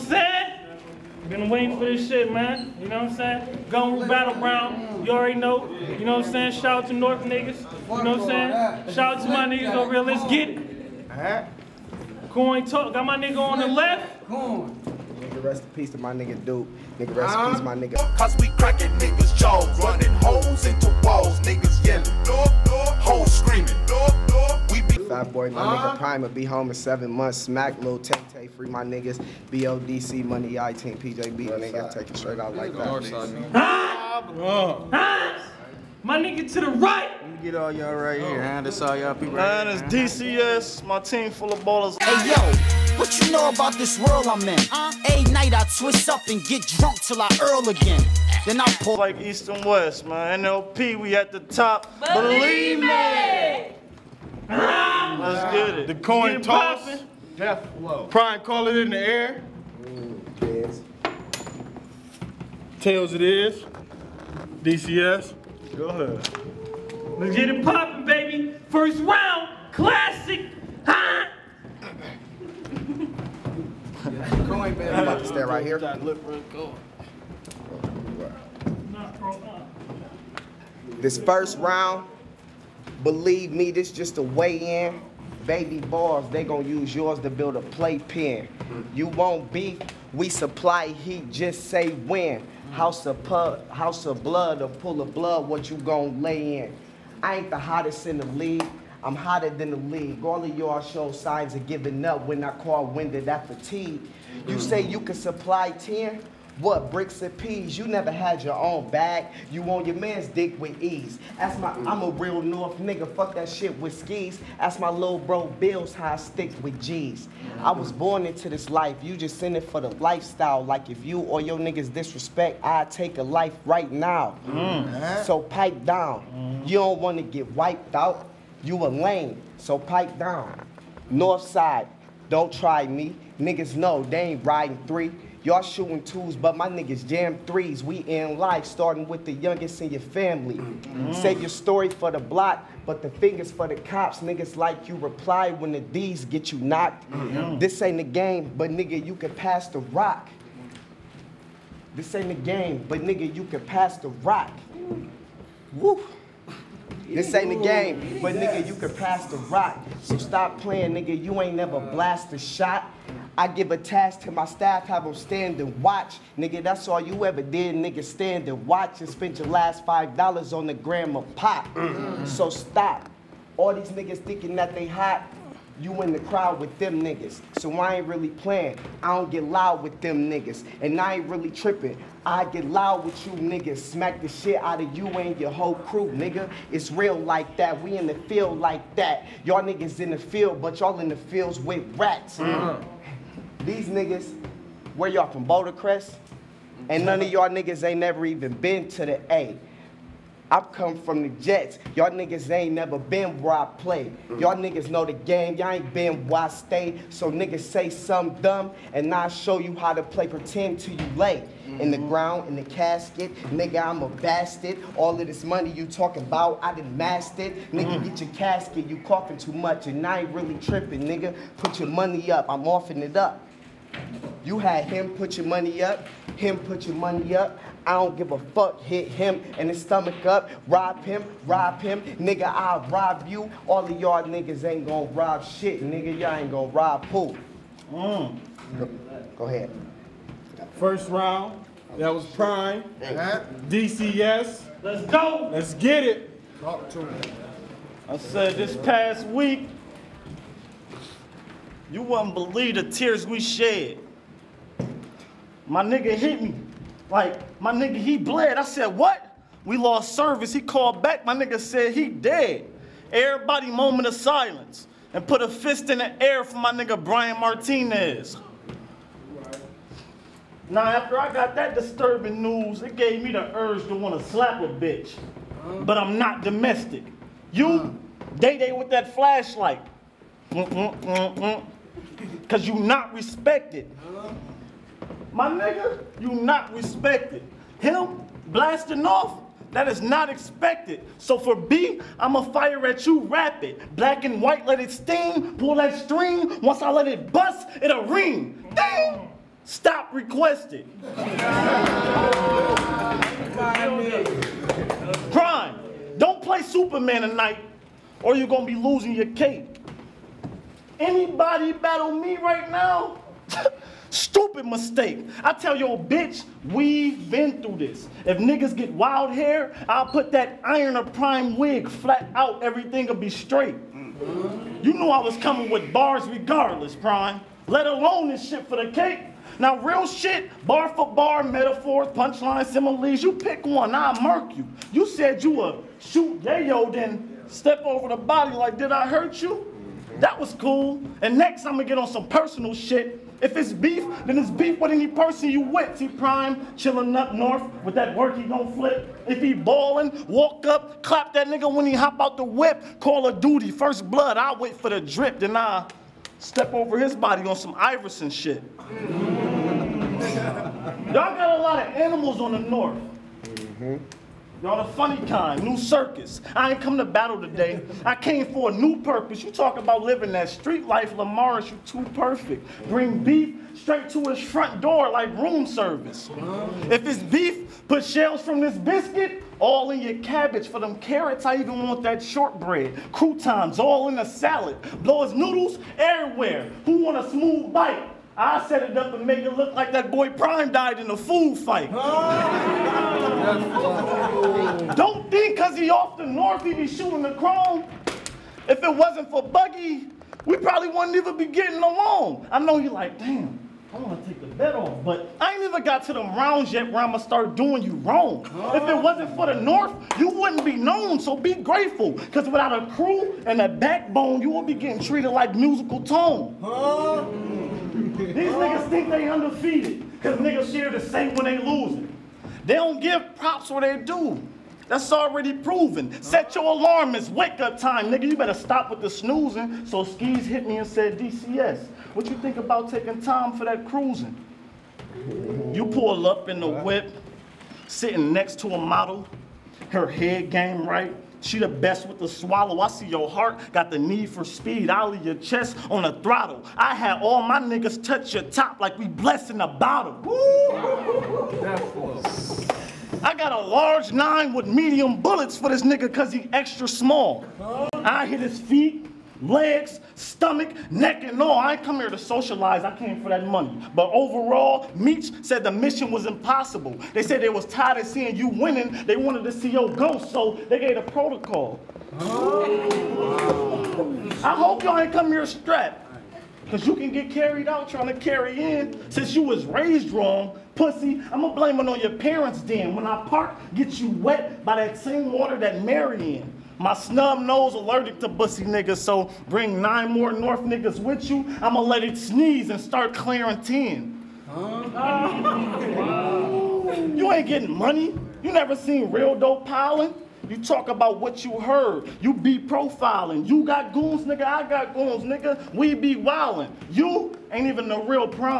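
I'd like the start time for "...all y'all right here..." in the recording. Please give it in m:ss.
0:37.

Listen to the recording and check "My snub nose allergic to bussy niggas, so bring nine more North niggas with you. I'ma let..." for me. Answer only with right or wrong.
right.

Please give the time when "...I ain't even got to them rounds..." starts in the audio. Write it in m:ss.
6:45.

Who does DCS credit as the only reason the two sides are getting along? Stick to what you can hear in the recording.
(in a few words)
Buggy.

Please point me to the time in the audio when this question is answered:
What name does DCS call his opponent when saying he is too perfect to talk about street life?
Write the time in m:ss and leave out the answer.
6:11.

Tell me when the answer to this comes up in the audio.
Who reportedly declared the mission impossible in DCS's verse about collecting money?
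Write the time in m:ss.
7:44.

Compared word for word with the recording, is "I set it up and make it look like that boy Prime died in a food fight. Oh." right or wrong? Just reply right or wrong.
right.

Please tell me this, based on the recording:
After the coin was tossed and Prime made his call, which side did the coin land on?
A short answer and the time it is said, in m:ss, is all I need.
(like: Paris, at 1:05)
Tails, at 1:02.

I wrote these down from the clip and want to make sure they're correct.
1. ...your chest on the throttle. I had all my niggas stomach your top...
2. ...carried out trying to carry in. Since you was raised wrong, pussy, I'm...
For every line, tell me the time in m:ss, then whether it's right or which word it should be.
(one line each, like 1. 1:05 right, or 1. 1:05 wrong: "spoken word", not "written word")
1. 7:25 wrong: "touch", not "stomach"
2. 7:57 right.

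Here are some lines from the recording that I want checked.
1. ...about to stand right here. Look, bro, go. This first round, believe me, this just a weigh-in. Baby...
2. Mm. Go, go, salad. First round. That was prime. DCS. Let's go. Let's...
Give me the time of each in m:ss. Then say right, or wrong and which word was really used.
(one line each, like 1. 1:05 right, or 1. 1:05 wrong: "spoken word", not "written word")
1. 1:15 right
2. 3:57 wrong: "ahead", not "salad".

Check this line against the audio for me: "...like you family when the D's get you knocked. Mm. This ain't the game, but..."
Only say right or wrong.
wrong.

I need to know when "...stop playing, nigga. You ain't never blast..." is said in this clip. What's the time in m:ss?
2:40.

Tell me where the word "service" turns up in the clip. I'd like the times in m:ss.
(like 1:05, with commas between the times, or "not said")
4:20, 6:15.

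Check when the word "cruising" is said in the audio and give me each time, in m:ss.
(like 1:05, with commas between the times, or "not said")
7:13.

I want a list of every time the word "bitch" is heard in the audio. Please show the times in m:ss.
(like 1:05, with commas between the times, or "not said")
4:34, 5:15.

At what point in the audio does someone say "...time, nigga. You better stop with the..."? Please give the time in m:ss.
7:07.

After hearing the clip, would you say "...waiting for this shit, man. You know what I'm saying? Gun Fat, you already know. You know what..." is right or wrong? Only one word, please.
wrong.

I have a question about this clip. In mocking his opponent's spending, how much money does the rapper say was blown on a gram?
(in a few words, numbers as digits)
$5.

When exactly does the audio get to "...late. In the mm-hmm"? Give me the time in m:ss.
3:31.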